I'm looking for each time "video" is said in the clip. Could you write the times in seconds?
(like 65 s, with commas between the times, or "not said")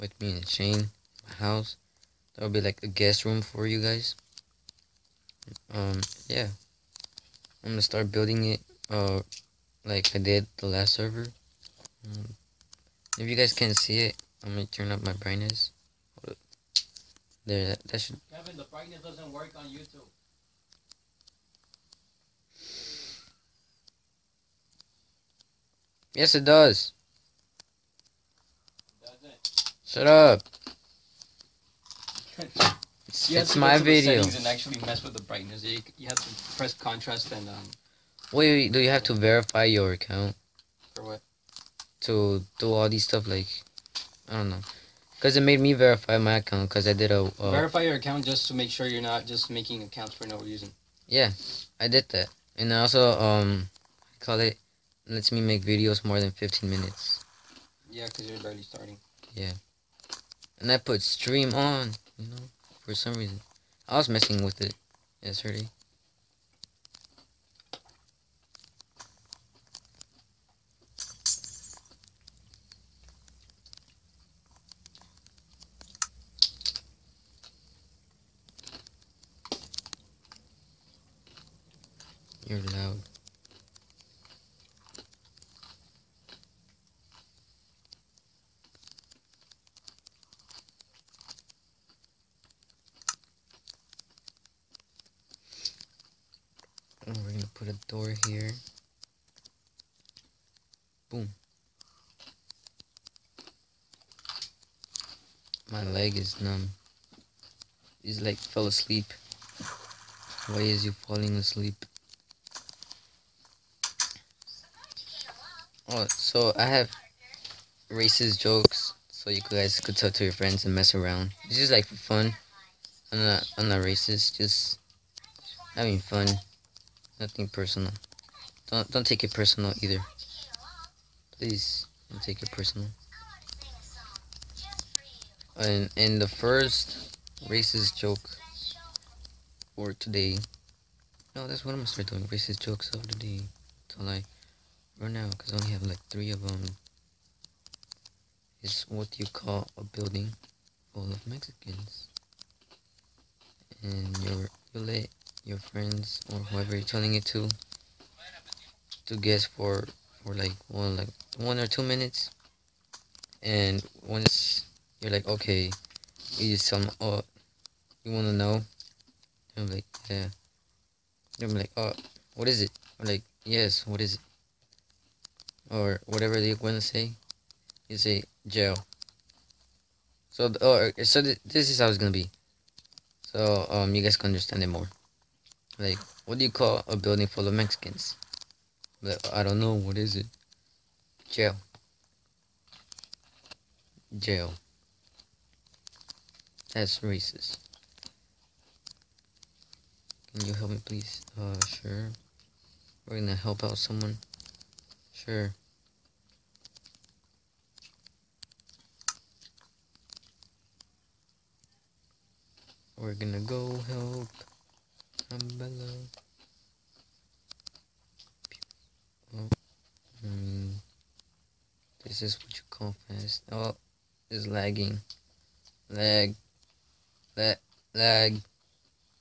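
33 s, 55 s.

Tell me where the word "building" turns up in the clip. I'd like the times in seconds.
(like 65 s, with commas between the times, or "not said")
8 s, 149 s, 186 s.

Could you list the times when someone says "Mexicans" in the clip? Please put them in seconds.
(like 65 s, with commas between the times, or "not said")
151 s, 187 s.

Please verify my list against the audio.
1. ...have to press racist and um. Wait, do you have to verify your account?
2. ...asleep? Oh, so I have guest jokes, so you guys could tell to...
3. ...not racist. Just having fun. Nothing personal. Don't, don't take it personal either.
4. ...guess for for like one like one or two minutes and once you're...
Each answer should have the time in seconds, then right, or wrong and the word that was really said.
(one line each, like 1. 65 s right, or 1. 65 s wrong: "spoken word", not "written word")
1. 36 s wrong: "contrast", not "racist"
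2. 111 s wrong: "racist", not "guest"
3. 123 s right
4. 159 s right.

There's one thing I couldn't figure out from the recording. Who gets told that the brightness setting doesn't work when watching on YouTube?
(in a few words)
Kevin.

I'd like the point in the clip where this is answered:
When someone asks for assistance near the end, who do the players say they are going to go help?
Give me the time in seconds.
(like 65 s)
215 s.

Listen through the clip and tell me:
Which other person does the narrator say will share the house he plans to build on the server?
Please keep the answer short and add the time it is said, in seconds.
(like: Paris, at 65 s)
Shane, at 0 s.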